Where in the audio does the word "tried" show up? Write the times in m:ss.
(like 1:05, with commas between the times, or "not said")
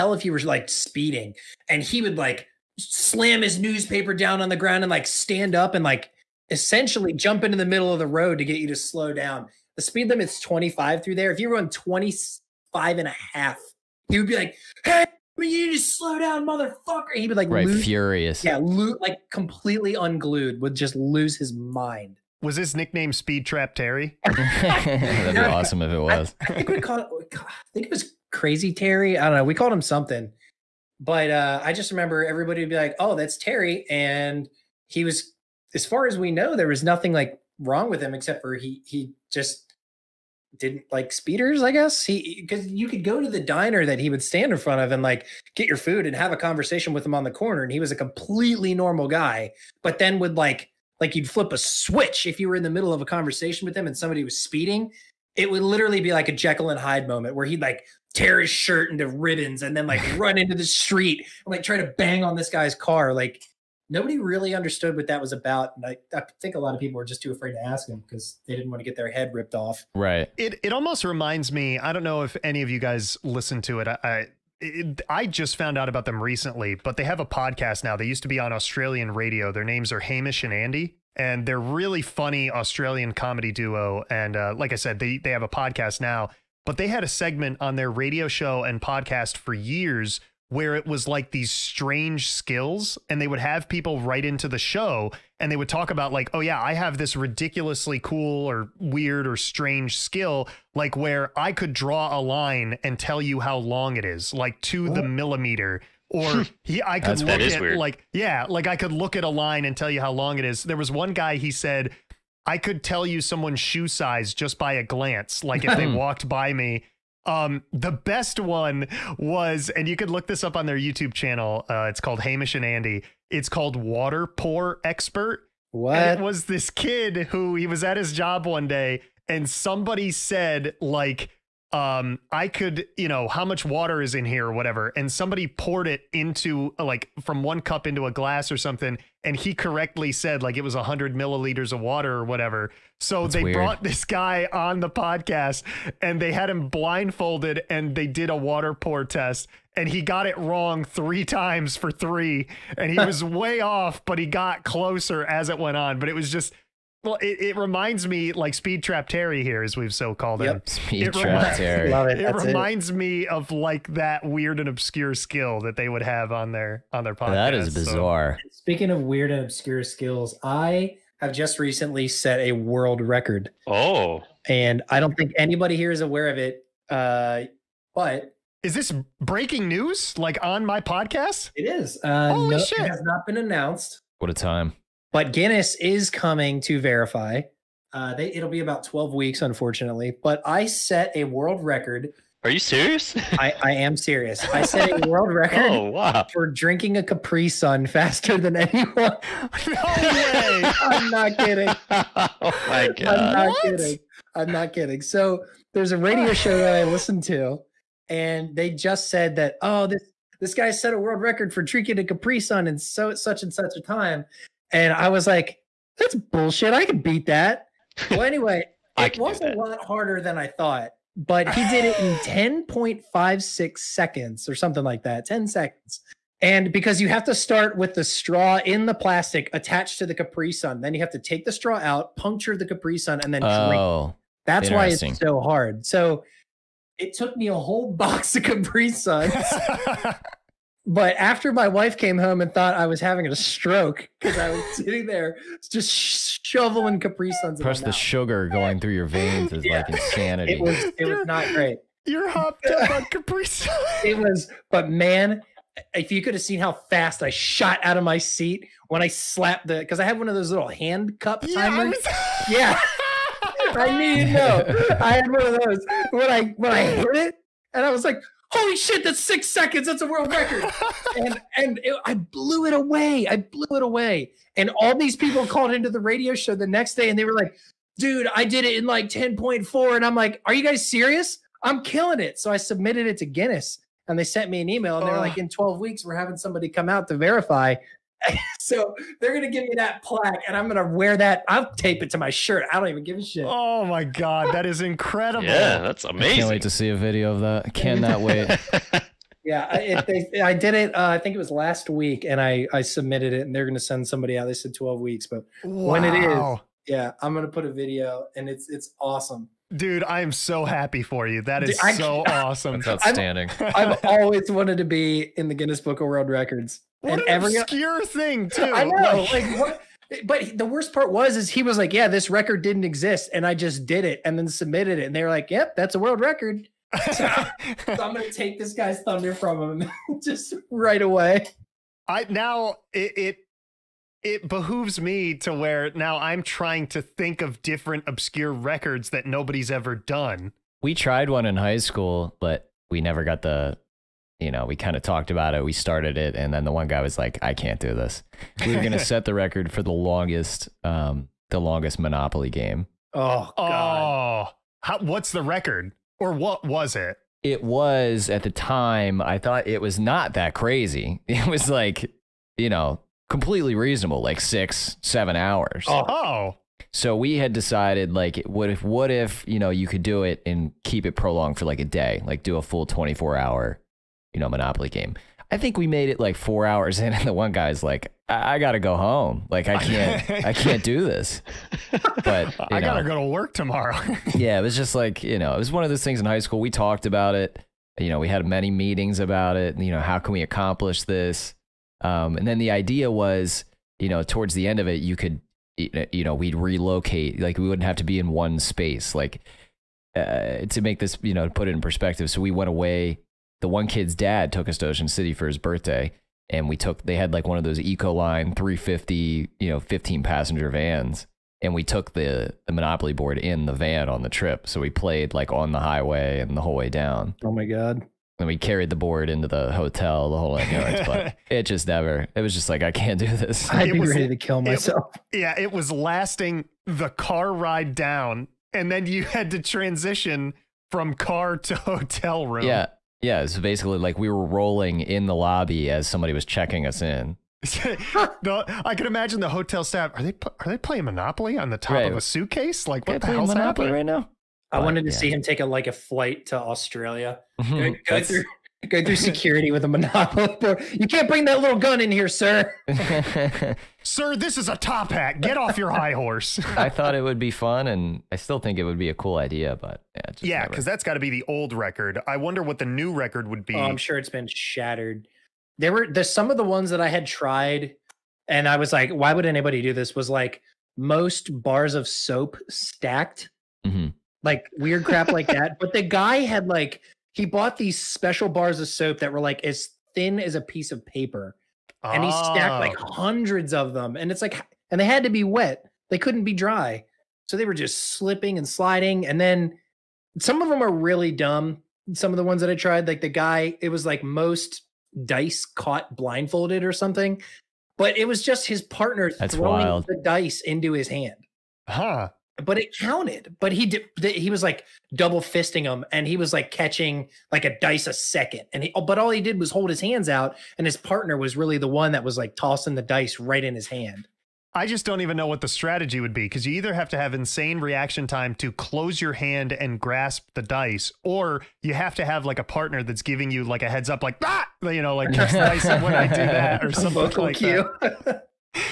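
5:40, 7:47, 8:12.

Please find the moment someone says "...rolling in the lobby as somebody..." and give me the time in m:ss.
7:14.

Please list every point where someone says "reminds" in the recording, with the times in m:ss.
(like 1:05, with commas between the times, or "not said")
1:11, 2:37, 2:42.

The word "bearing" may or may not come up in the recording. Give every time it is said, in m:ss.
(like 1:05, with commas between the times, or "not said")
not said.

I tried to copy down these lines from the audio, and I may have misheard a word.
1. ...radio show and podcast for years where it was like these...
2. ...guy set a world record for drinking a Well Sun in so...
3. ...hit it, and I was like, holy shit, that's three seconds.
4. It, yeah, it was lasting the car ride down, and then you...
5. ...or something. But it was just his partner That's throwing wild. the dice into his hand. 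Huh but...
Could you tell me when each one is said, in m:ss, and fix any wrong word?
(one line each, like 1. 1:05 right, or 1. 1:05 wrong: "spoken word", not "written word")
1. 1:27 right
2. 3:30 wrong: "Capri", not "Well"
3. 4:26 wrong: "six", not "three"
4. 7:05 right
5. 8:16 right.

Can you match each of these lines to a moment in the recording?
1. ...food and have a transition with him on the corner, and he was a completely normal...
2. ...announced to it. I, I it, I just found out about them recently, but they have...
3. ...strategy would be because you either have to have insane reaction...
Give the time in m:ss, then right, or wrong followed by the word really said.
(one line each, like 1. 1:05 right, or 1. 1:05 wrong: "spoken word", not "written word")
1. 0:45 wrong: "conversation", not "transition"
2. 1:13 wrong: "listened", not "announced"
3. 8:35 right.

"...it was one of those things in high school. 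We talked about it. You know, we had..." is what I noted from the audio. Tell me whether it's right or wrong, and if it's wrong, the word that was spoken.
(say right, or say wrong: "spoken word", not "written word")
right.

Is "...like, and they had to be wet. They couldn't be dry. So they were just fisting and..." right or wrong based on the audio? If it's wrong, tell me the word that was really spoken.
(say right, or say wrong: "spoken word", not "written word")
wrong: "slipping", not "fisting".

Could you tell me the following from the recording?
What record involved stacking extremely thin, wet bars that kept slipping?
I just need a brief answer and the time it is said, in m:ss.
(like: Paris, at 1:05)
most bars of soap stacked, at 7:50.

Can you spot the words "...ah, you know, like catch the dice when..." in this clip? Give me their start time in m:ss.
8:44.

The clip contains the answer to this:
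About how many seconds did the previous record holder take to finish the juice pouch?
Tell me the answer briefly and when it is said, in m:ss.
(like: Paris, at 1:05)
10.56 seconds, at 3:42.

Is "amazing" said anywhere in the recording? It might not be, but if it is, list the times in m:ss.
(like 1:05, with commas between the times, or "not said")
4:56.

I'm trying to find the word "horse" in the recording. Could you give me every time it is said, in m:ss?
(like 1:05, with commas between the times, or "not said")
7:36.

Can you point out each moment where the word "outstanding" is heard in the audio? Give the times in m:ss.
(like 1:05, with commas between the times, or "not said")
5:13.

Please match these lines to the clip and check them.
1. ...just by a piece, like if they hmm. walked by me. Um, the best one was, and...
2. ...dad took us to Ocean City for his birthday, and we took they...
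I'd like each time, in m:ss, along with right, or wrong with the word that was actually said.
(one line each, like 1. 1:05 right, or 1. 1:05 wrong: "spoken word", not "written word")
1. 1:54 wrong: "glance", not "piece"
2. 6:44 right.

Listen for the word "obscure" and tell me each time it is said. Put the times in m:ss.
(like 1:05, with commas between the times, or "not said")
2:44, 2:49, 5:17, 5:38.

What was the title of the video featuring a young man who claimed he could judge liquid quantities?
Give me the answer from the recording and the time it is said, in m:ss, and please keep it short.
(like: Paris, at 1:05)
Water Pour Expert, at 2:03.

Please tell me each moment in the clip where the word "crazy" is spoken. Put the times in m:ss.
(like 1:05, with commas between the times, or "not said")
0:28, 6:00.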